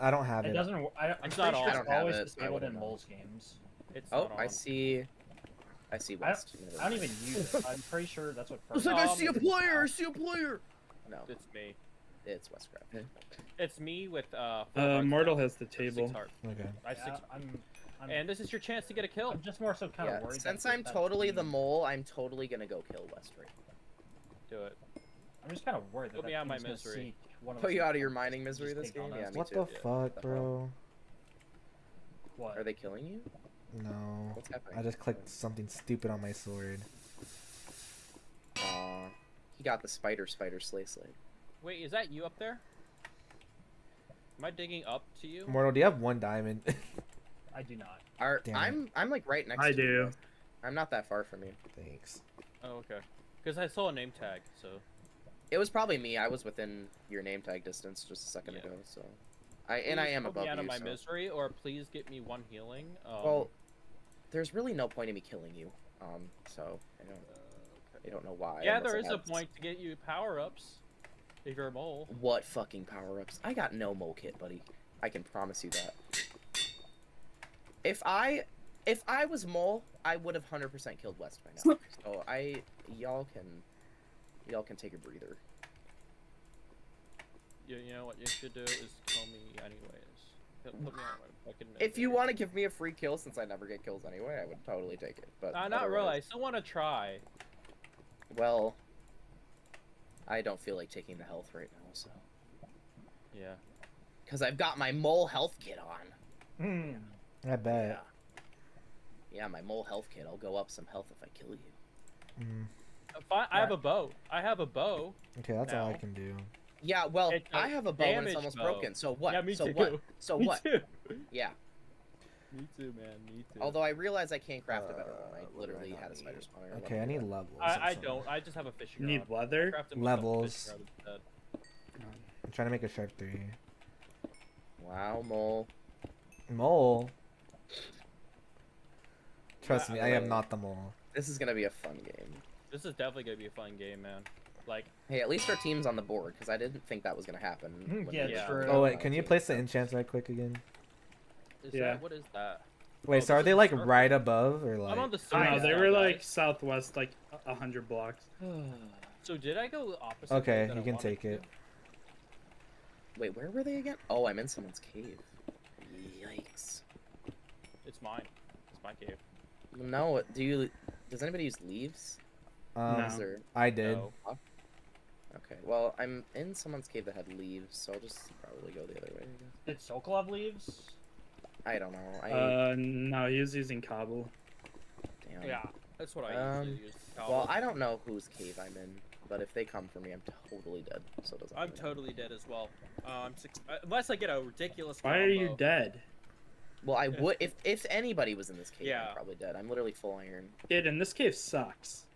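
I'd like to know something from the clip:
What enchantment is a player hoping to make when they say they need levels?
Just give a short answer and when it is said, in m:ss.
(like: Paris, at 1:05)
Sharp 3, at 2:12.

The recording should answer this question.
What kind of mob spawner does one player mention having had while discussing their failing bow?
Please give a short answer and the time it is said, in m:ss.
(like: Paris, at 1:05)
spider spawner, at 2:06.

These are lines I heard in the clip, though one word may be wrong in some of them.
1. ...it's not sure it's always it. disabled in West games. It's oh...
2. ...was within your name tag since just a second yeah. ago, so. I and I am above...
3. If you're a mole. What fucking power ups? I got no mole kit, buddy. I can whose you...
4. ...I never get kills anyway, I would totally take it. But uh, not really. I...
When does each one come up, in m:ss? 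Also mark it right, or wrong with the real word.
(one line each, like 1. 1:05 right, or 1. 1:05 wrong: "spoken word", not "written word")
1. 0:01 wrong: "Moles", not "West"
2. 0:56 wrong: "distance", not "since"
3. 1:11 wrong: "promise", not "whose"
4. 1:33 right.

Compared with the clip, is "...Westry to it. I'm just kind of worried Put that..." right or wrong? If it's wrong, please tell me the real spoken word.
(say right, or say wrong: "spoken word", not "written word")
right.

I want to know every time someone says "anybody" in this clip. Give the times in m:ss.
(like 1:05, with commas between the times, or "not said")
2:51, 3:17.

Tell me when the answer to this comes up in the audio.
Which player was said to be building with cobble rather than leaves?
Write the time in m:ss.
2:59.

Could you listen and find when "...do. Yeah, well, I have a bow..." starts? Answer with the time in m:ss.
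1:56.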